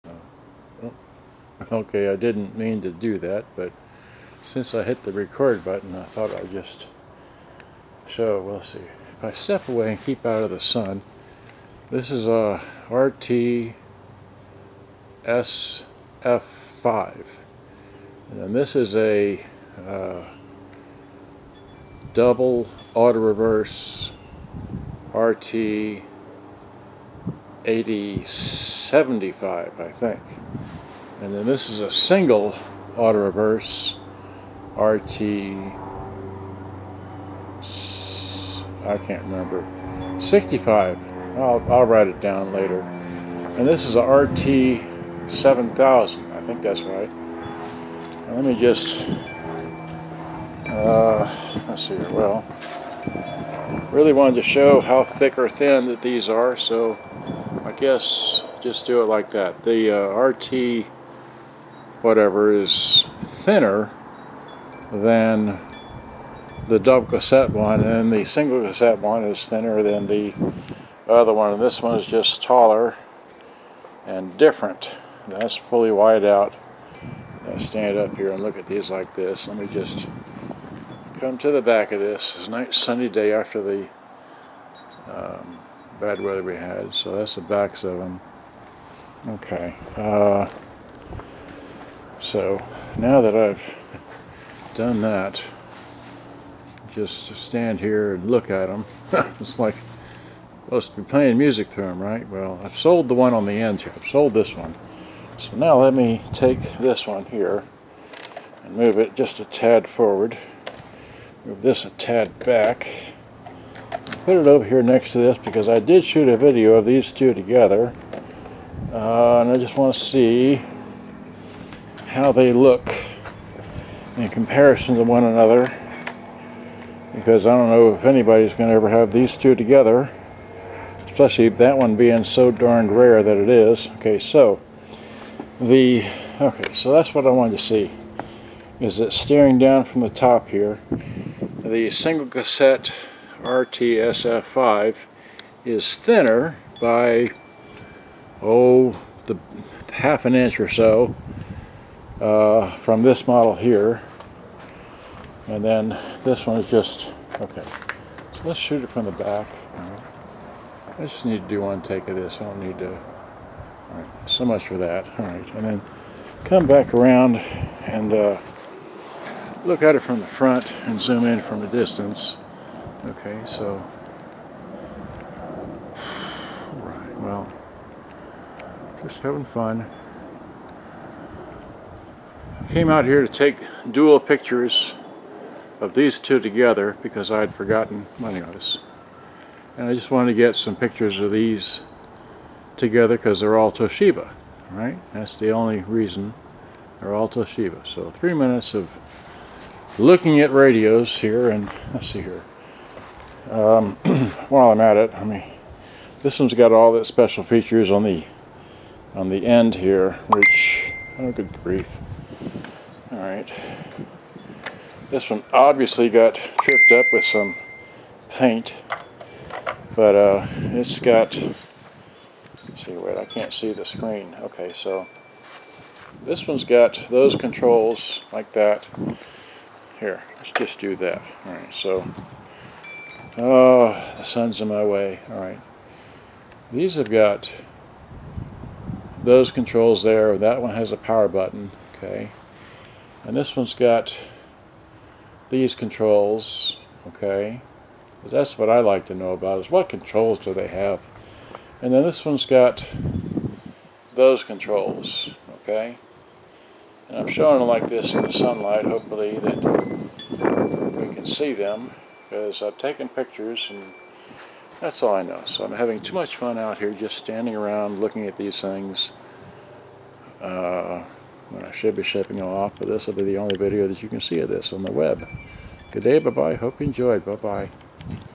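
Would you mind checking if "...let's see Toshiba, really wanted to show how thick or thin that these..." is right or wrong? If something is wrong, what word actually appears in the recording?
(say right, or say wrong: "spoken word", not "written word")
wrong: "Well", not "Toshiba".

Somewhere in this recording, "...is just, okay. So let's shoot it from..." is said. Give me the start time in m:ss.
2:36.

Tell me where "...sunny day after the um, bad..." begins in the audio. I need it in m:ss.
1:22.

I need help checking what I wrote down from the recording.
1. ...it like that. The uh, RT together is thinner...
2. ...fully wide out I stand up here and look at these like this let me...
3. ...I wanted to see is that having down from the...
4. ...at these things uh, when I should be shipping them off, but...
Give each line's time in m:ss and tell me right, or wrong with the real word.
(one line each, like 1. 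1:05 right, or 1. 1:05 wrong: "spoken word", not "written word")
1. 0:59 wrong: "whatever", not "together"
2. 1:15 right
3. 2:17 wrong: "staring", not "having"
4. 4:28 right.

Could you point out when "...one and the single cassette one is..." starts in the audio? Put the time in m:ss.
1:07.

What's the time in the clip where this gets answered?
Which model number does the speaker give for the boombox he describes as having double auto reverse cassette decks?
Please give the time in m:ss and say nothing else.
0:25.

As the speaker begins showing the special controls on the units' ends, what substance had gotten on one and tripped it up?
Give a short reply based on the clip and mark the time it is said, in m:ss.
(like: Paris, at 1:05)
paint, at 3:38.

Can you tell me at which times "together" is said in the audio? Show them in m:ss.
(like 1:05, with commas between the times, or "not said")
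1:57, 2:09, 3:06, 3:12.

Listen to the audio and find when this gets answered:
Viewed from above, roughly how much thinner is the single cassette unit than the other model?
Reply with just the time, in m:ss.
2:29.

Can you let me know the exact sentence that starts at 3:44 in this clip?
Okay, so this one's got those controls like that.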